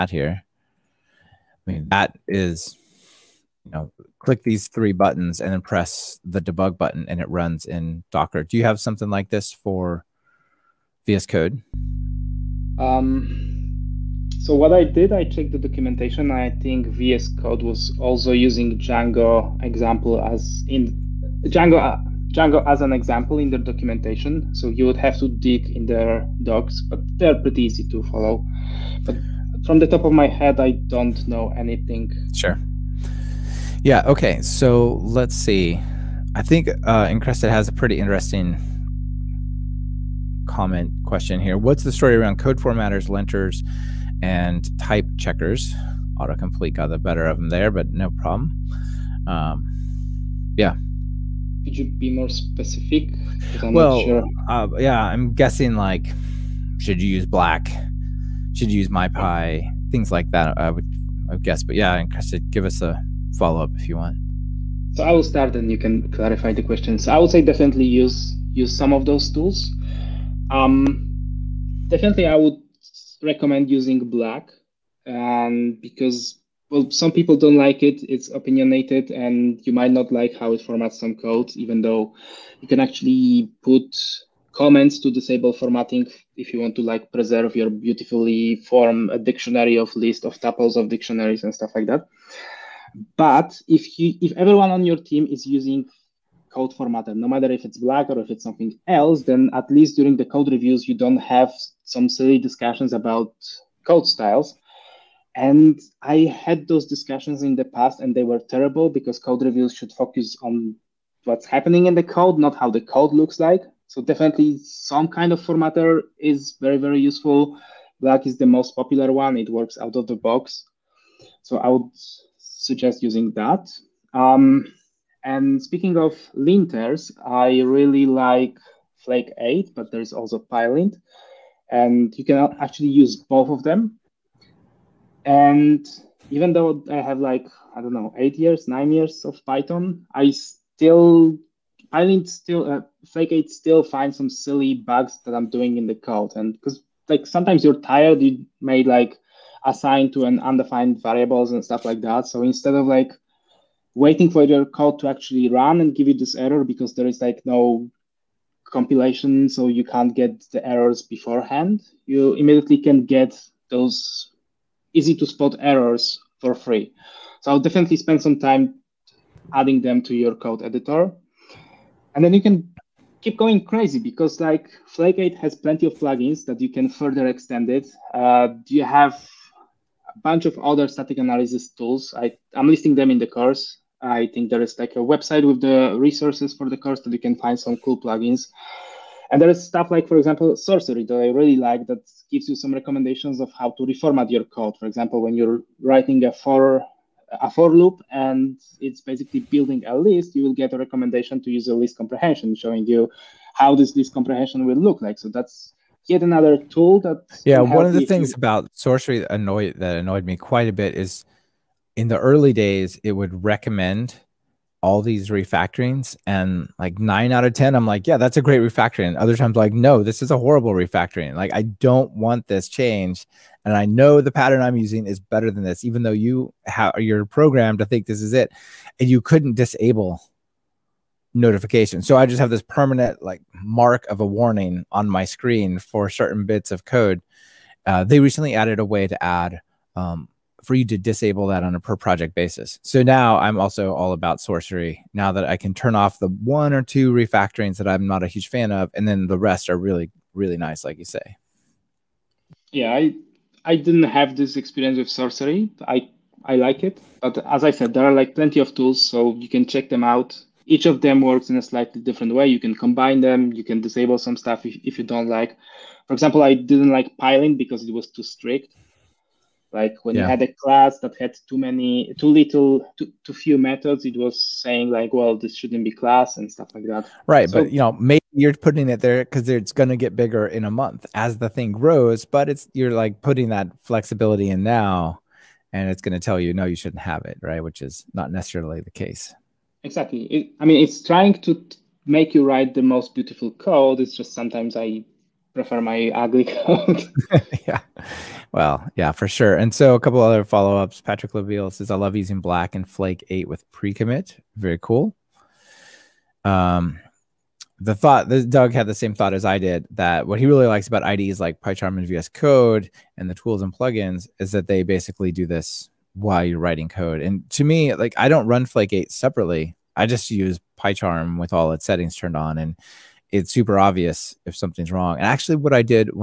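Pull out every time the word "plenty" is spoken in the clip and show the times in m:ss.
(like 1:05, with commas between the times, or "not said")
2:55, 4:18.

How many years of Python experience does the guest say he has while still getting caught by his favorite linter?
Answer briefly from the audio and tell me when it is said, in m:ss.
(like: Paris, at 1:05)
9, at 2:18.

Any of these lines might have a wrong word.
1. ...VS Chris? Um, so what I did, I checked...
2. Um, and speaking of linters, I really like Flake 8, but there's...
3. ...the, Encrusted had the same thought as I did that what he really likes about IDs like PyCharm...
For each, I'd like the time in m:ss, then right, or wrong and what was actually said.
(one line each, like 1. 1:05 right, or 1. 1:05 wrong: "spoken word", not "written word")
1. 0:11 wrong: "Code", not "Chris"
2. 2:04 right
3. 5:08 wrong: "Doug", not "Encrusted".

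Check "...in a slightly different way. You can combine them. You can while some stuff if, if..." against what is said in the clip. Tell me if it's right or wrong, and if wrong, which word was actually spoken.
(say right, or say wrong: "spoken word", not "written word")
wrong: "disable", not "while".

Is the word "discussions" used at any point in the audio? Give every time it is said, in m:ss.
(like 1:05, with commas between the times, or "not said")
1:42, 1:46.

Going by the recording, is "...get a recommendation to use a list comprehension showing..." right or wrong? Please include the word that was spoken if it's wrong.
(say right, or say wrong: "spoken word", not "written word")
right.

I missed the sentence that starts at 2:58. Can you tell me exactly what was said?
Uh, you have a bunch of other static analysis tools.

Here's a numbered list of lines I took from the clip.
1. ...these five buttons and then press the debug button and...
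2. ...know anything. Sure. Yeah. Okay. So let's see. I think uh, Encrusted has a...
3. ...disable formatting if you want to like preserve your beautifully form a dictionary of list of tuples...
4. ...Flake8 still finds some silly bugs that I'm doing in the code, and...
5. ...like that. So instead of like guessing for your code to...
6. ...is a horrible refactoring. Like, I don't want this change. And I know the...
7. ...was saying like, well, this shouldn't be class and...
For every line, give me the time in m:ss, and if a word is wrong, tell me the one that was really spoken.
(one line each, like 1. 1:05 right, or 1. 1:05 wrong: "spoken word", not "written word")
1. 0:04 wrong: "three", not "five"
2. 0:31 right
3. 1:25 right
4. 2:23 right
5. 2:31 wrong: "waiting", not "guessing"
6. 3:40 right
7. 4:34 right.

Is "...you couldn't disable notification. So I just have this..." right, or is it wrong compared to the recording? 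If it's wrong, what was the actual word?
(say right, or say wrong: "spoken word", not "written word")
right.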